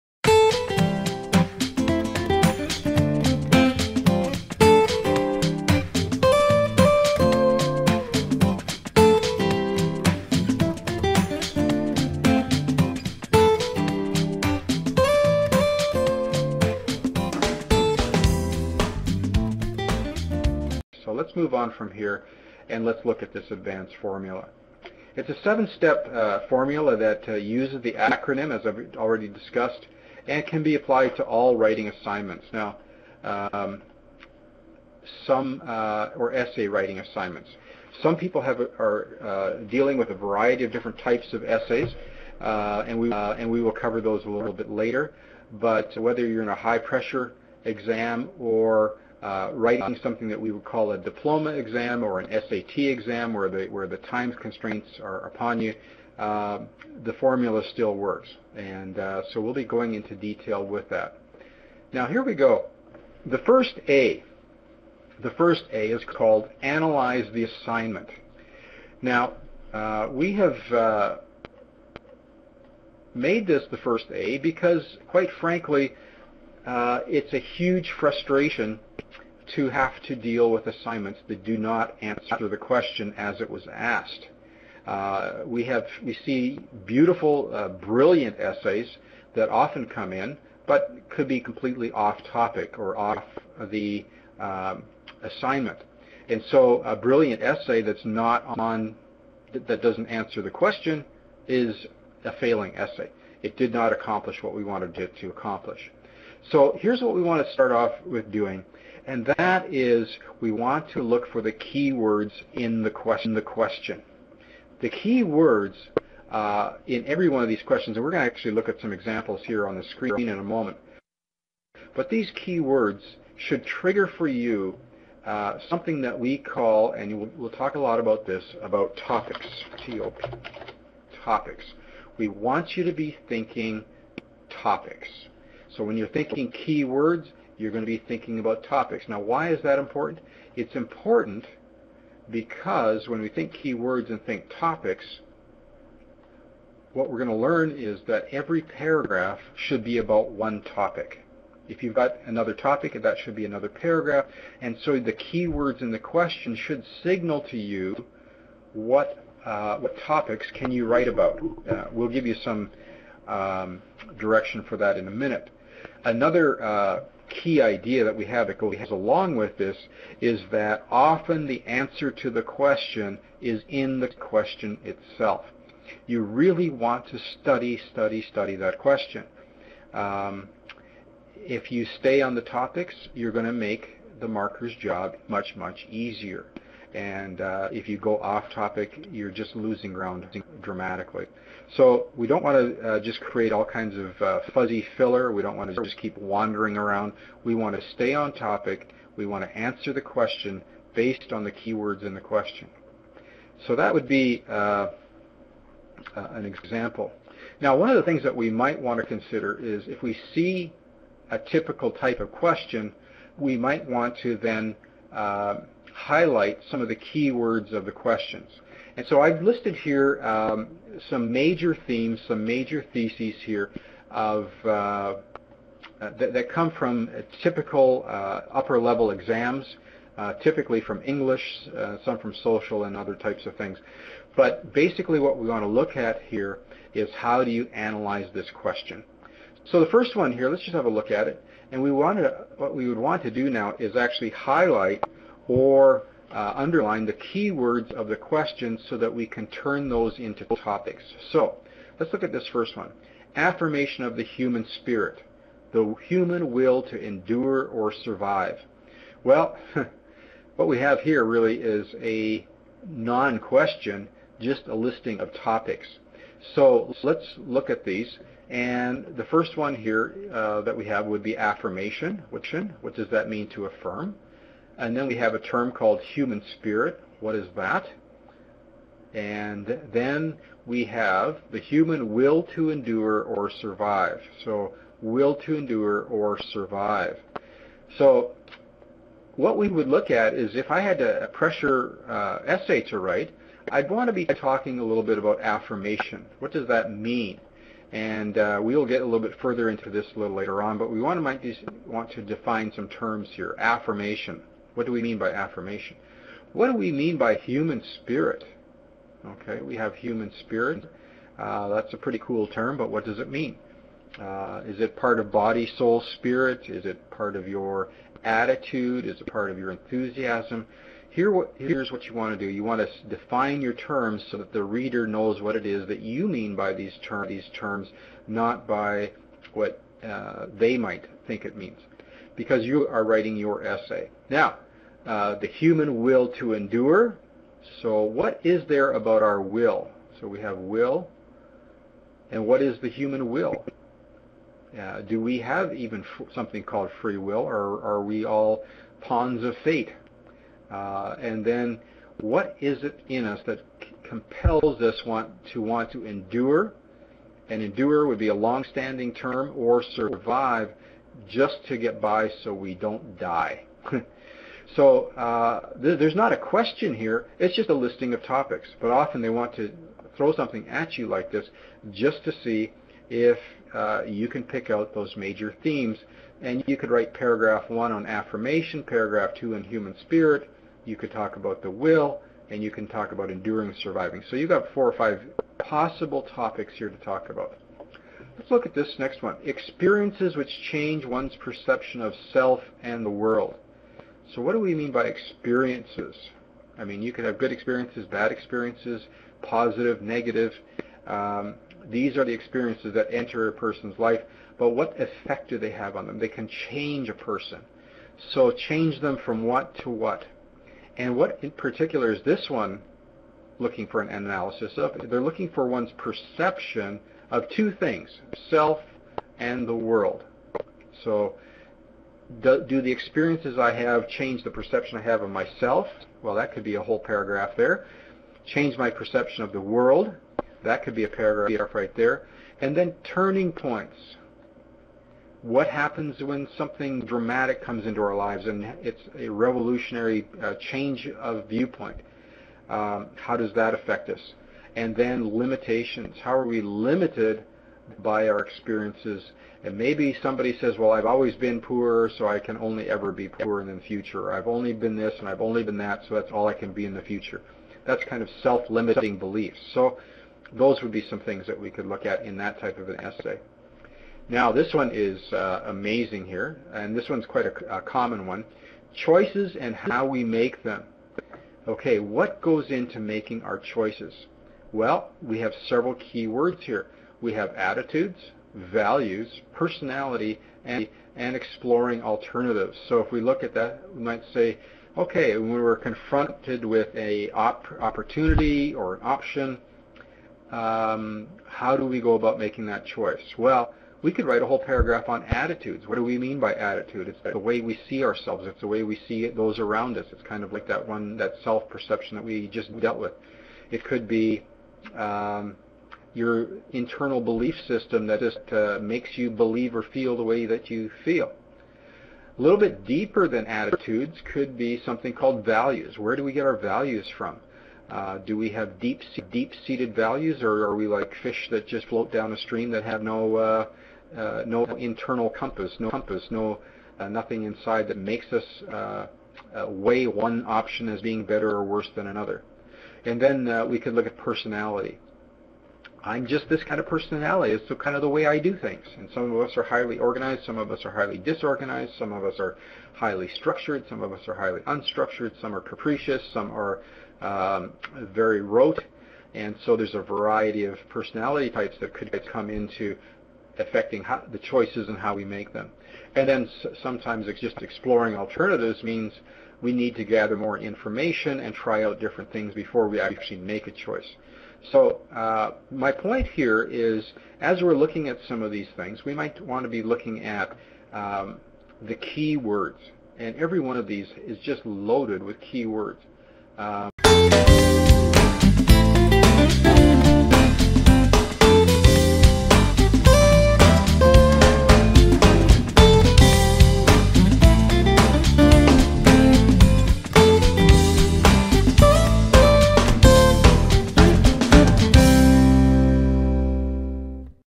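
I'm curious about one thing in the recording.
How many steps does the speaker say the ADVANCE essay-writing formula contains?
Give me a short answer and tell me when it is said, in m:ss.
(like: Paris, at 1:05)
7, at 0:25.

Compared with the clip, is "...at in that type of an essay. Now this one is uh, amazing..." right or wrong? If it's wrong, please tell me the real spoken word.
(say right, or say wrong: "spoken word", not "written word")
right.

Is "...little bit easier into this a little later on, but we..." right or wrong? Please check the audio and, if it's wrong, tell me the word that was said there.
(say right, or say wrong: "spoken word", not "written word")
wrong: "further", not "easier".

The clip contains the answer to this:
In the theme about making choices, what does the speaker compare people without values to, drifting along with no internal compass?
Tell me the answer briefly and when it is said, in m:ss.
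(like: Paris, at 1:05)
fish, at 8:41.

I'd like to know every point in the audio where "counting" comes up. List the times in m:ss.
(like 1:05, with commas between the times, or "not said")
not said.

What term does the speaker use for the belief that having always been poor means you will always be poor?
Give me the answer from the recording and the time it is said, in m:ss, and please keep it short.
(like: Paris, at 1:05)
self-limiting beliefs, at 7:38.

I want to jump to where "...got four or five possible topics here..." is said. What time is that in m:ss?
6:24.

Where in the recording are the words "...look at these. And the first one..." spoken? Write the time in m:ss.
4:27.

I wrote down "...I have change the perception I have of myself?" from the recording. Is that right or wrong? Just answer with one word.
right.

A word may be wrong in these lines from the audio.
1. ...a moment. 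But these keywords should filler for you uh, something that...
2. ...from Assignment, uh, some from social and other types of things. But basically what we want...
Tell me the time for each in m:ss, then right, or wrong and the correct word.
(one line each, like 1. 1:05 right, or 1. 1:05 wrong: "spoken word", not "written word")
1. 2:00 wrong: "trigger", not "filler"
2. 3:50 wrong: "English", not "Assignment".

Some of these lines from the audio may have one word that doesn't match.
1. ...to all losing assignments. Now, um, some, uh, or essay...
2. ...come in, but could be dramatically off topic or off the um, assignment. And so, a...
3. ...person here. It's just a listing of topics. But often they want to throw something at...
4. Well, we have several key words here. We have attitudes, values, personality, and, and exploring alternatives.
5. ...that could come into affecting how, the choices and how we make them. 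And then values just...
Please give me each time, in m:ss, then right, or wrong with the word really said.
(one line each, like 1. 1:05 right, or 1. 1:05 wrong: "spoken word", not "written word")
1. 0:31 wrong: "writing", not "losing"
2. 1:29 wrong: "completely", not "dramatically"
3. 6:06 wrong: "question", not "person"
4. 7:54 right
5. 9:11 wrong: "sometimes", not "values".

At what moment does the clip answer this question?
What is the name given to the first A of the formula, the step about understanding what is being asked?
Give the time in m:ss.
1:06.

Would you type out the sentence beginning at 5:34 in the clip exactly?
Now, uh, the human will to endure.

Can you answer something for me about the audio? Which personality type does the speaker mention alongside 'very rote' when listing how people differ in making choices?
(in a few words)
capricious.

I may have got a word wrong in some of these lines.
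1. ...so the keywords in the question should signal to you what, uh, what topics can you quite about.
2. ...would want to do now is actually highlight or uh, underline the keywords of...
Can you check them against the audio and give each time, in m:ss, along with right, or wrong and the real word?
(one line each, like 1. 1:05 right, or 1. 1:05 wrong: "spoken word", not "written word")
1. 2:34 wrong: "write", not "quite"
2. 4:02 right.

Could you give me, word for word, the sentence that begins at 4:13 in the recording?
Affirmation of the human spirit, the human will to endure or survive.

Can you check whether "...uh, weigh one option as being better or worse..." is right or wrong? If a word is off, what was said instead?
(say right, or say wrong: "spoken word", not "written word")
right.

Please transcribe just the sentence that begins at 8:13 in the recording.
Well, we could write a whole paragraph on attitudes.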